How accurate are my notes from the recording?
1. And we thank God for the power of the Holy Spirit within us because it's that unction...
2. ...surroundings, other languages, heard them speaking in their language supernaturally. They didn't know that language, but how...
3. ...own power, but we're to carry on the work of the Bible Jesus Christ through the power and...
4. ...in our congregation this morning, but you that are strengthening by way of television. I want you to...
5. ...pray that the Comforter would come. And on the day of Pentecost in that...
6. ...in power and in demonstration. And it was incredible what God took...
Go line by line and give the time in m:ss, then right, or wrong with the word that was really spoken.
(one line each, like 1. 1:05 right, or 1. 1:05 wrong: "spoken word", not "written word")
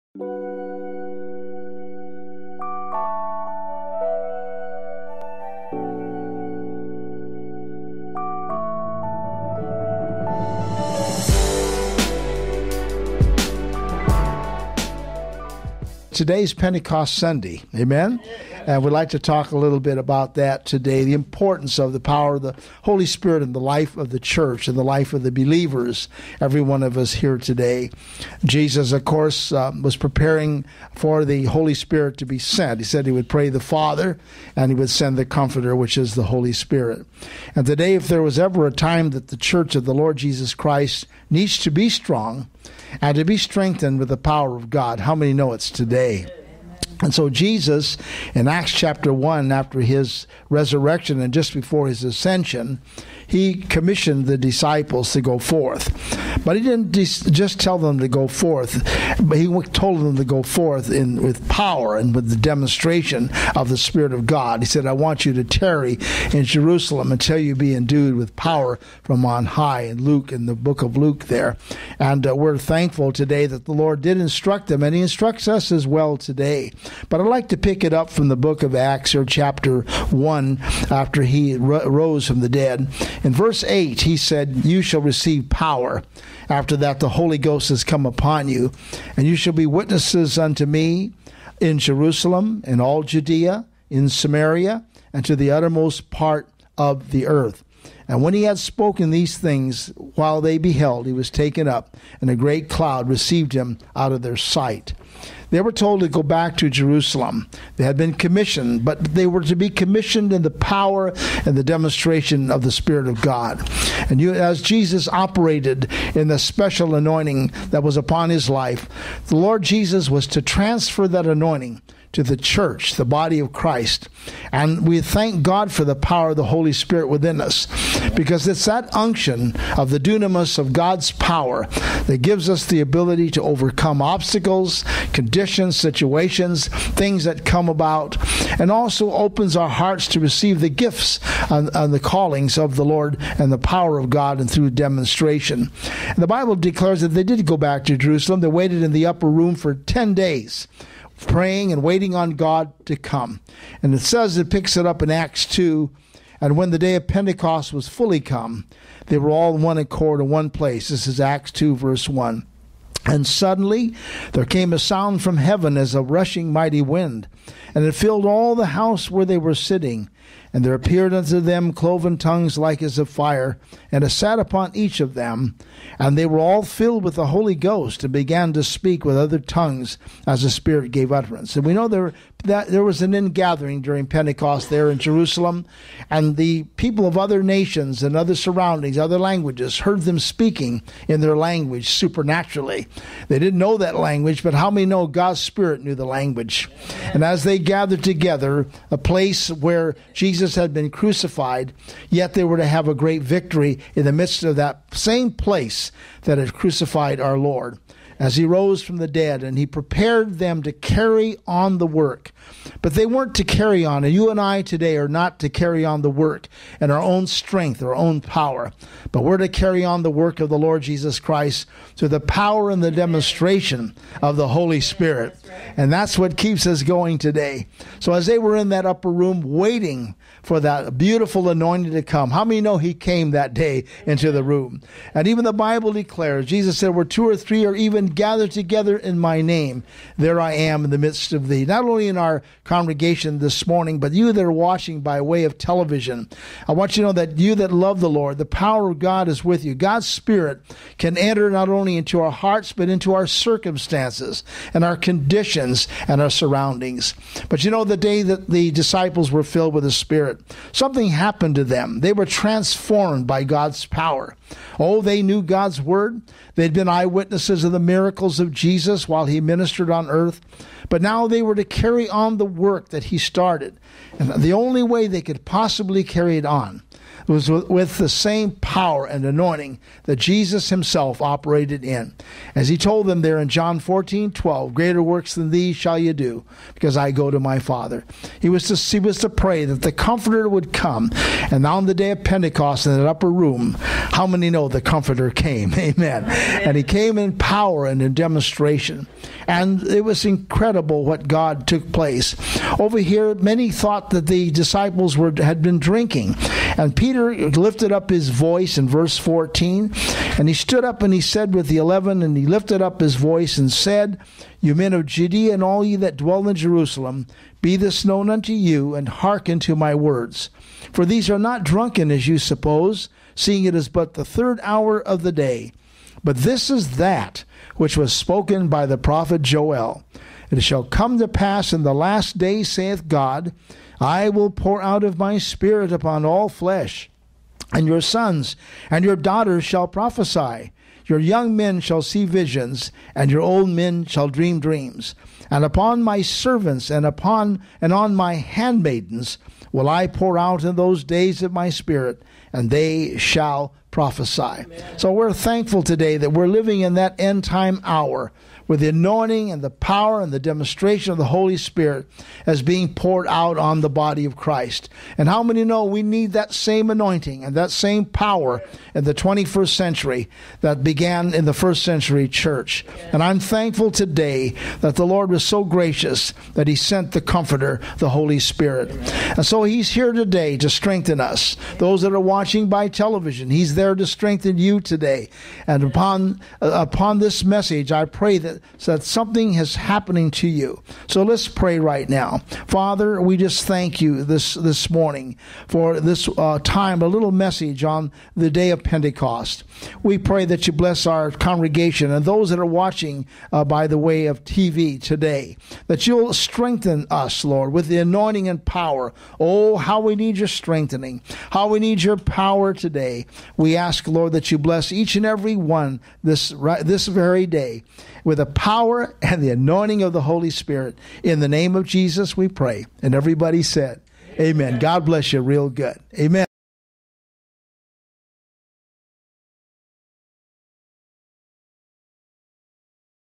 1. 2:04 right
2. 3:08 right
3. 3:37 wrong: "Lord", not "Bible"
4. 4:02 wrong: "watching", not "strengthening"
5. 4:49 right
6. 4:57 right.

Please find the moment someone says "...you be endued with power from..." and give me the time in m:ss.
1:07.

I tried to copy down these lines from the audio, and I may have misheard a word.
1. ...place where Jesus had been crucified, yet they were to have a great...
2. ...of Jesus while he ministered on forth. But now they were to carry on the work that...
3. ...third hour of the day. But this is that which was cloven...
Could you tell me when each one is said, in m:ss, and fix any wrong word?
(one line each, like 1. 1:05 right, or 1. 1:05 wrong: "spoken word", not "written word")
1. 3:18 right
2. 4:28 wrong: "earth", not "forth"
3. 5:24 wrong: "spoken", not "cloven".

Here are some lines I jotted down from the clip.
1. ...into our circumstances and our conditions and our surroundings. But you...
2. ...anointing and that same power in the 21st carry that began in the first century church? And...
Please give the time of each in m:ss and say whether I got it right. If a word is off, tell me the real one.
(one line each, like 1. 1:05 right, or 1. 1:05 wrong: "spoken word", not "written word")
1. 4:12 right
2. 6:06 wrong: "century", not "carry".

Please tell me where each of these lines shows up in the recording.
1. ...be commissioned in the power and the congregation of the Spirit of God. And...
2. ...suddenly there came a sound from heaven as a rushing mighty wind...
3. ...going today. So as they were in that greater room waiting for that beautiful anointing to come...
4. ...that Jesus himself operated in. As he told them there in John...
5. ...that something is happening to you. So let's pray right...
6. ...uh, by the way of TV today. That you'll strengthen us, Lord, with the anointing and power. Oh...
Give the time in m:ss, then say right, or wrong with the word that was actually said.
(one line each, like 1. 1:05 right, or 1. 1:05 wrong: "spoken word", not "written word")
1. 1:49 wrong: "demonstration", not "congregation"
2. 2:43 right
3. 3:46 wrong: "upper", not "greater"
4. 4:40 right
5. 6:28 right
6. 6:43 right.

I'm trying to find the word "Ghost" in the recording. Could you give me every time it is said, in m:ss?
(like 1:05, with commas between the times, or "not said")
1:27, 2:57.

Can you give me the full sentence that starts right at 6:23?
He's there to strengthen you today.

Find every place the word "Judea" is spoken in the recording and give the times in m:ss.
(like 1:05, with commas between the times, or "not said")
1:33, 5:15.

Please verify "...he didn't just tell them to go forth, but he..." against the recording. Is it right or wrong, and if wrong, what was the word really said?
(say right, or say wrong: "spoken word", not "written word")
right.